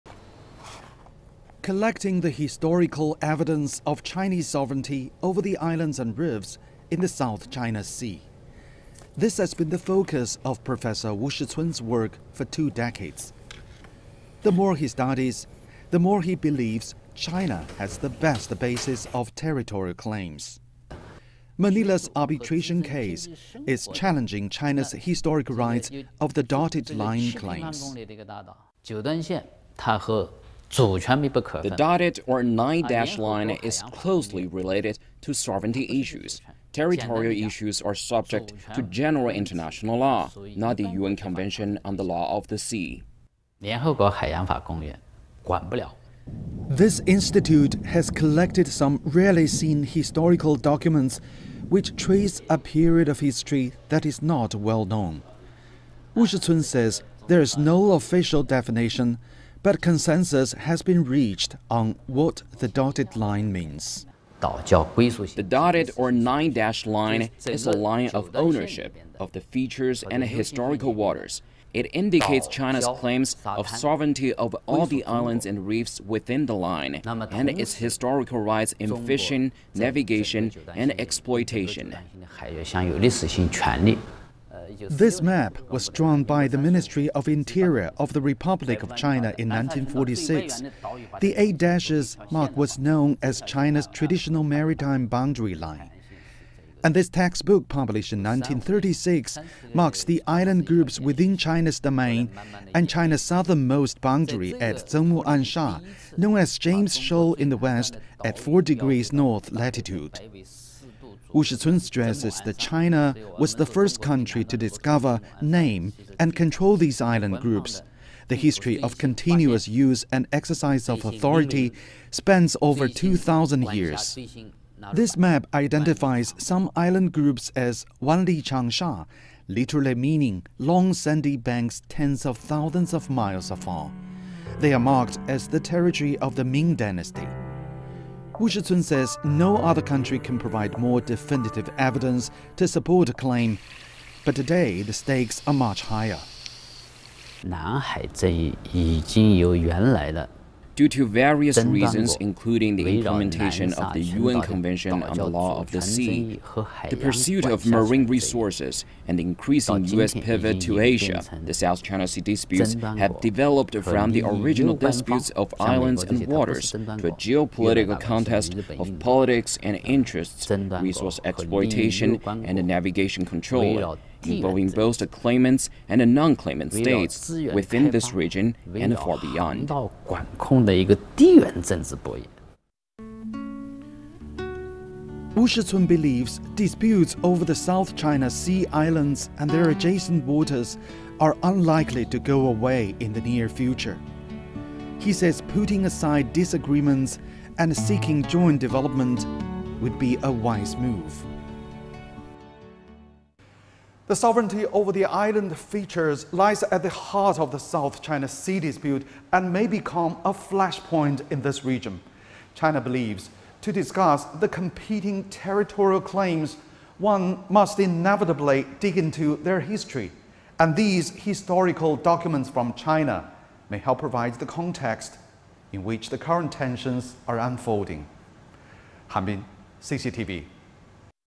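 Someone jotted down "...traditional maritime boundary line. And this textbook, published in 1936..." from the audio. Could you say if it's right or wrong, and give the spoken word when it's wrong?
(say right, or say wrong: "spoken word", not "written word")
right.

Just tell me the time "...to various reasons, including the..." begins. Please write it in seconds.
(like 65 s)
150 s.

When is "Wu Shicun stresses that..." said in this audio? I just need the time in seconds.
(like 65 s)
111 s.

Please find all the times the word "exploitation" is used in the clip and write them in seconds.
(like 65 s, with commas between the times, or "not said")
80 s, 171 s.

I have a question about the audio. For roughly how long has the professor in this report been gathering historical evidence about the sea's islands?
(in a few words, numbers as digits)
2 decades.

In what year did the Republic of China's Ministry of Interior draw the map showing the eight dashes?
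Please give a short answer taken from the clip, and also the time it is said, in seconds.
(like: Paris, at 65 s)
1946, at 89 s.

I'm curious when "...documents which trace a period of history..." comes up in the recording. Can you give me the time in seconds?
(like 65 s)
50 s.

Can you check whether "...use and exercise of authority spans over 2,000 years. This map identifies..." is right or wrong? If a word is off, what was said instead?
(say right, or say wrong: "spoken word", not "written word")
right.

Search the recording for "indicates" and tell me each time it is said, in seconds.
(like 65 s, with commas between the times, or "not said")
71 s.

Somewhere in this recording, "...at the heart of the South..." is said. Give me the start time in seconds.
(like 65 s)
206 s.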